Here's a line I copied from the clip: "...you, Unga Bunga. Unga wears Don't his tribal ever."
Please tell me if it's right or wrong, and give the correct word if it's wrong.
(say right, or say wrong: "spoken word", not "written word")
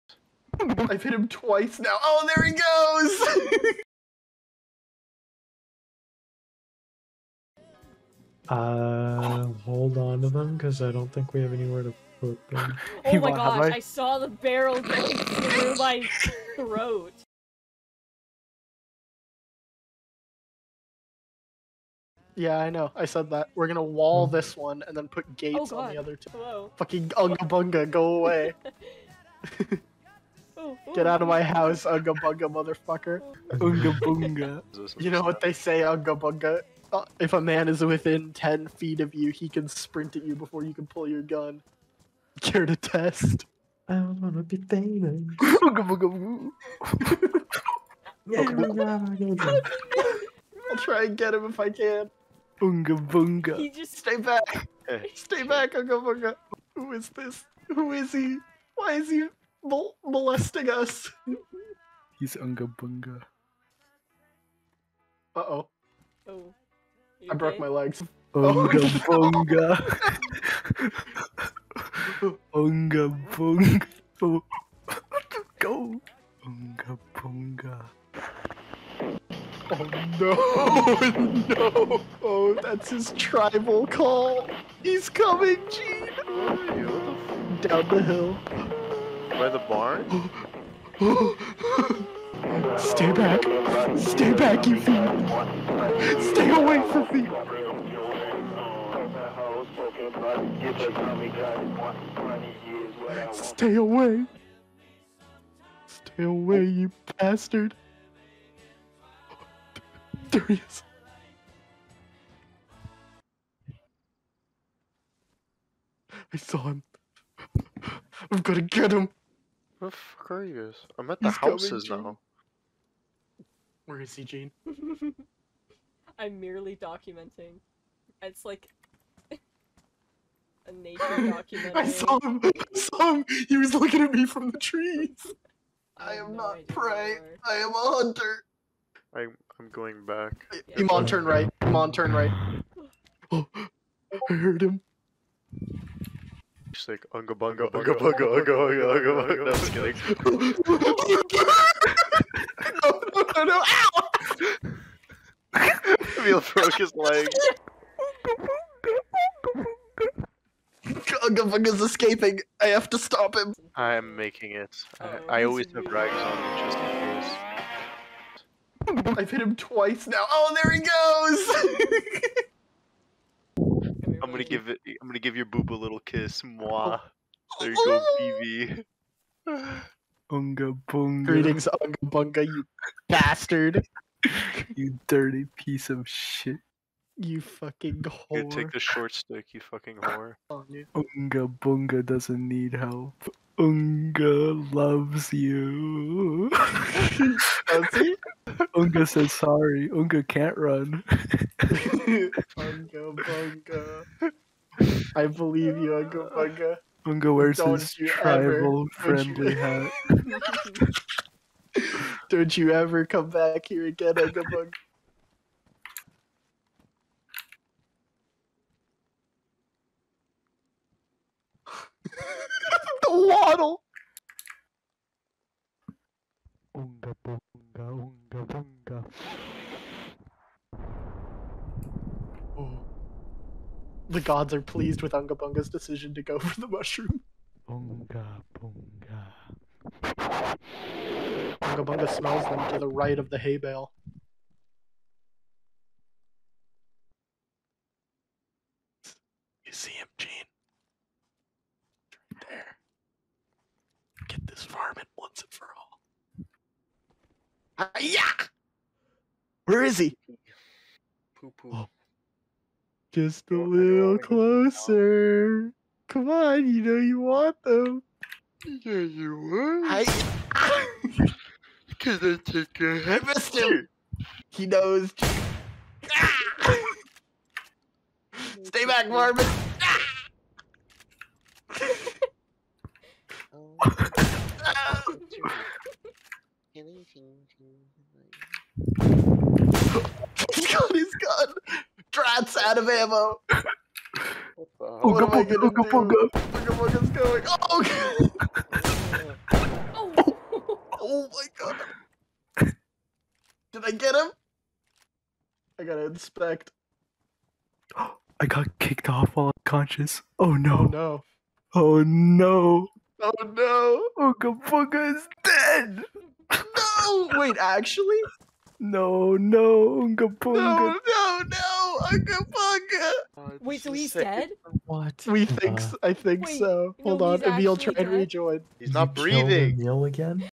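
right.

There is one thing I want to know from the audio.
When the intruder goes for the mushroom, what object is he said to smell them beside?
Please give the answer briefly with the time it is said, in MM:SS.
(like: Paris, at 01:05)
hay bale, at 04:03.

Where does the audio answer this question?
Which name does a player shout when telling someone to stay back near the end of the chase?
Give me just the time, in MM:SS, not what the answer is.
04:39.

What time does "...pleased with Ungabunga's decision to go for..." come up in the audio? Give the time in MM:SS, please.
03:54.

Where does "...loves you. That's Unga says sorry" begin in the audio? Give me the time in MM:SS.
03:14.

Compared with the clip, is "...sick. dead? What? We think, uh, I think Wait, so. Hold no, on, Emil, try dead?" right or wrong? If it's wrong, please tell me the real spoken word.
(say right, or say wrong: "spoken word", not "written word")
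right.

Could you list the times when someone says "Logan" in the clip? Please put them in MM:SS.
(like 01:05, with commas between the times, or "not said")
not said.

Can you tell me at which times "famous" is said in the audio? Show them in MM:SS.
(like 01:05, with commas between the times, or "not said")
00:44.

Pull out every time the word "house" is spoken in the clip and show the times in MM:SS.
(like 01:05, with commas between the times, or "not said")
00:31, 02:01.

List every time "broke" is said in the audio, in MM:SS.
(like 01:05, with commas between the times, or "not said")
01:07, 02:36.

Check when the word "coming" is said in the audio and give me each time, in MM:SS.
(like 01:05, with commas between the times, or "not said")
01:25, 02:01.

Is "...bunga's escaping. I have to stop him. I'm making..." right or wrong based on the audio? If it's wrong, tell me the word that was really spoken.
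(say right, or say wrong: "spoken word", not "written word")
right.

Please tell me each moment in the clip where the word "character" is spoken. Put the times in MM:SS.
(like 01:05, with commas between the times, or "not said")
not said.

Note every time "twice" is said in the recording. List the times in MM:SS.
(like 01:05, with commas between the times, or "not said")
00:01, 02:49.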